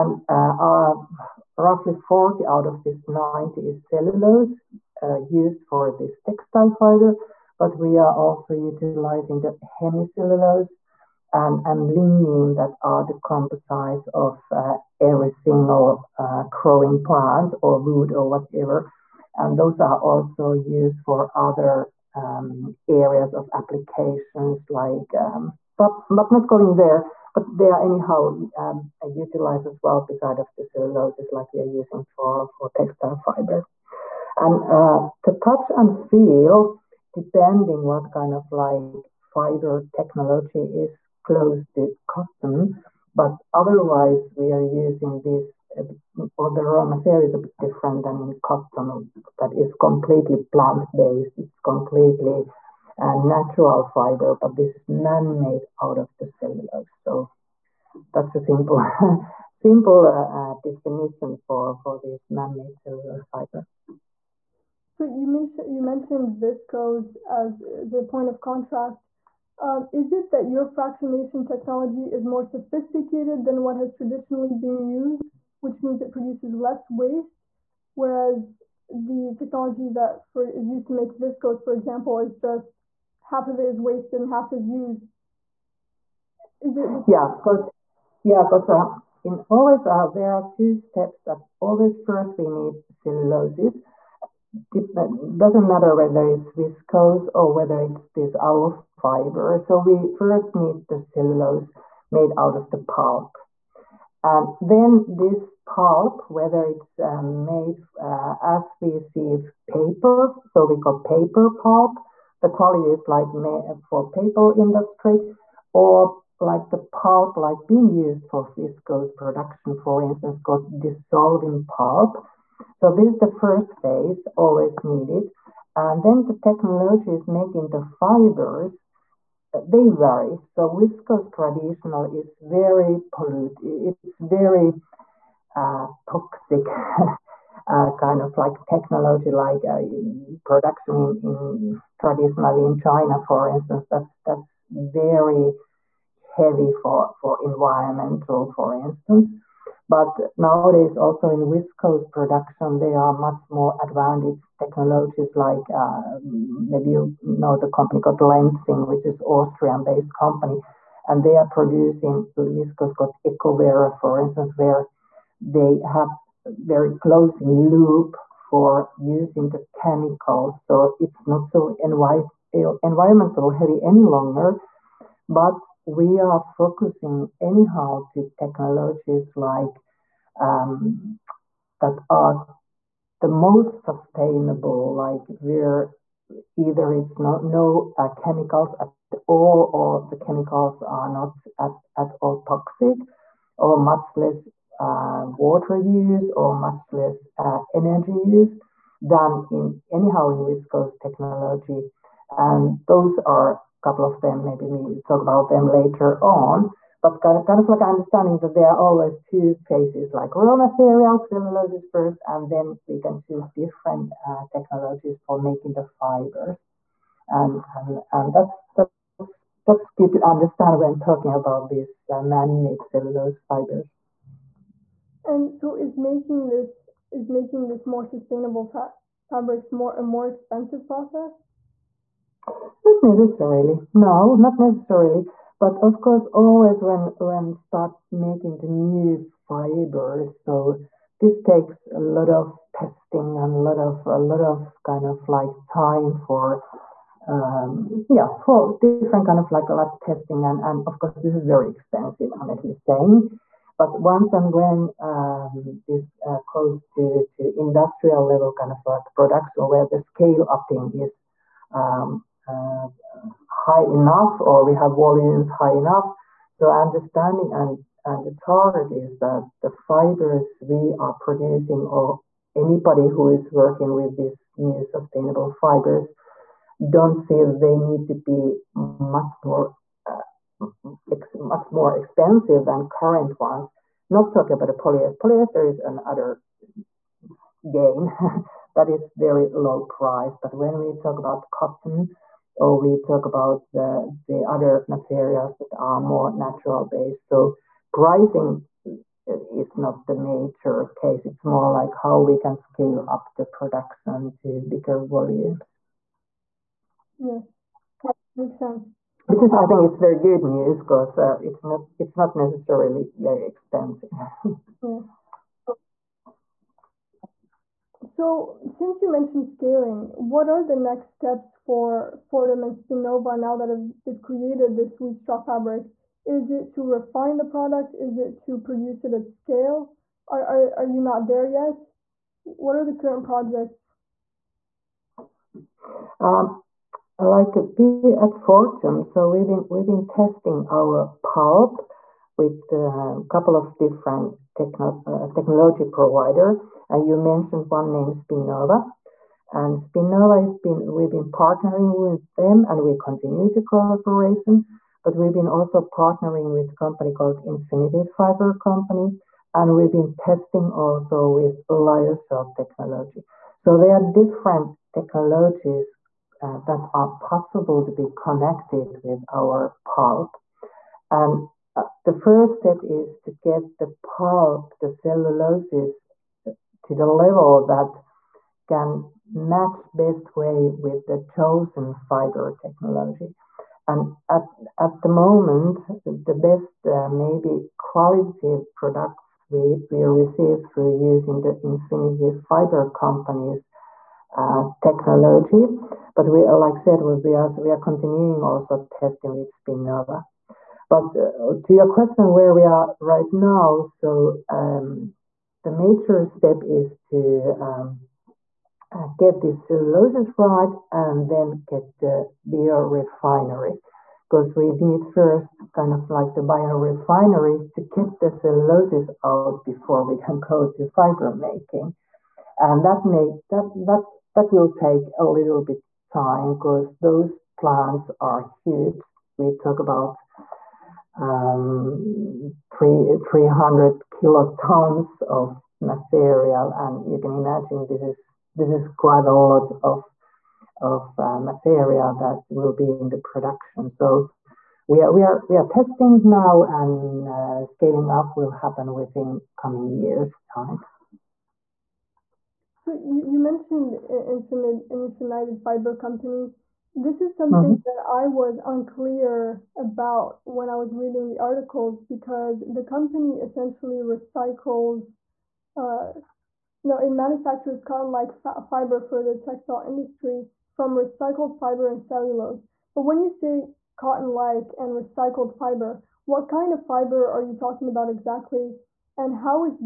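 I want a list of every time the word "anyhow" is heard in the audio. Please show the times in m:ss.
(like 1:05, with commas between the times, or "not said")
0:27, 2:57, 3:19.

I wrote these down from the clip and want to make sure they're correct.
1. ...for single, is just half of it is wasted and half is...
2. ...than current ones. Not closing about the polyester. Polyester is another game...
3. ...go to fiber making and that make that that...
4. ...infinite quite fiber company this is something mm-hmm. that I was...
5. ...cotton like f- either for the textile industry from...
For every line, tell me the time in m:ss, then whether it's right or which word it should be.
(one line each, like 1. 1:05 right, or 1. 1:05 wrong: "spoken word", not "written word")
1. 1:21 wrong: "example", not "single"
2. 4:42 wrong: "talking", not "closing"
3. 7:00 right
4. 7:34 wrong: "infinite", not "quite"
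5. 7:47 wrong: "fiber", not "either".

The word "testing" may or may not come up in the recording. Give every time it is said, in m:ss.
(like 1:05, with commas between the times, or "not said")
4:02, 4:09, 5:40, 6:00, 6:38, 7:25.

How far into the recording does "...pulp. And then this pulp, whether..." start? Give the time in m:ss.
1:42.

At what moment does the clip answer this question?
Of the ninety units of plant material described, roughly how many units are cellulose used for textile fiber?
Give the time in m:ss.
0:01.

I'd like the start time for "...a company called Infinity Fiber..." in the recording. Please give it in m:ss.
5:56.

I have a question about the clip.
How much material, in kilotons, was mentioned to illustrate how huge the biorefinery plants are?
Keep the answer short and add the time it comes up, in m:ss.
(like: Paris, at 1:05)
300 kilotons, at 7:13.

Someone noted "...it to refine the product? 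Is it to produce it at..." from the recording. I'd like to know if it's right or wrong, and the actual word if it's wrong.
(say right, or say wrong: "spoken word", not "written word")
right.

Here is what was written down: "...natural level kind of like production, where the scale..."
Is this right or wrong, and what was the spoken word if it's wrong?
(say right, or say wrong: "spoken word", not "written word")
wrong: "industrial", not "natural".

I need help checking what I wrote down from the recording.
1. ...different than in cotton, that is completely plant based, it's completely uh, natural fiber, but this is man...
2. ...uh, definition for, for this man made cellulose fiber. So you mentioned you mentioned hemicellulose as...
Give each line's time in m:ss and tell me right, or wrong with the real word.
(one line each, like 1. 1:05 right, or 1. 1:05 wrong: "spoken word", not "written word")
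1. 0:47 right
2. 1:00 wrong: "viscose", not "hemicellulose".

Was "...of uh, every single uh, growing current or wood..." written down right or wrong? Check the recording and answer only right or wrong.
wrong.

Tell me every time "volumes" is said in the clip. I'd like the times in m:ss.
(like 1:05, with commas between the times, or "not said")
4:24, 5:05.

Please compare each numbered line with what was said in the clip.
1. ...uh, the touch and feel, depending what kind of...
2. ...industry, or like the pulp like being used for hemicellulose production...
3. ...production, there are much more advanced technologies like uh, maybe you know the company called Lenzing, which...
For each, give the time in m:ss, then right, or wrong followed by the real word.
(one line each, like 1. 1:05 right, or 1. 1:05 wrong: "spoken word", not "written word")
1. 0:34 right
2. 1:54 wrong: "viscose", not "hemicellulose"
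3. 2:32 right.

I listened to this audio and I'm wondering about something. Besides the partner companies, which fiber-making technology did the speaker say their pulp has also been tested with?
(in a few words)
Lyocell.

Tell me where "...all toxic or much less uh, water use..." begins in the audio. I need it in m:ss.
3:12.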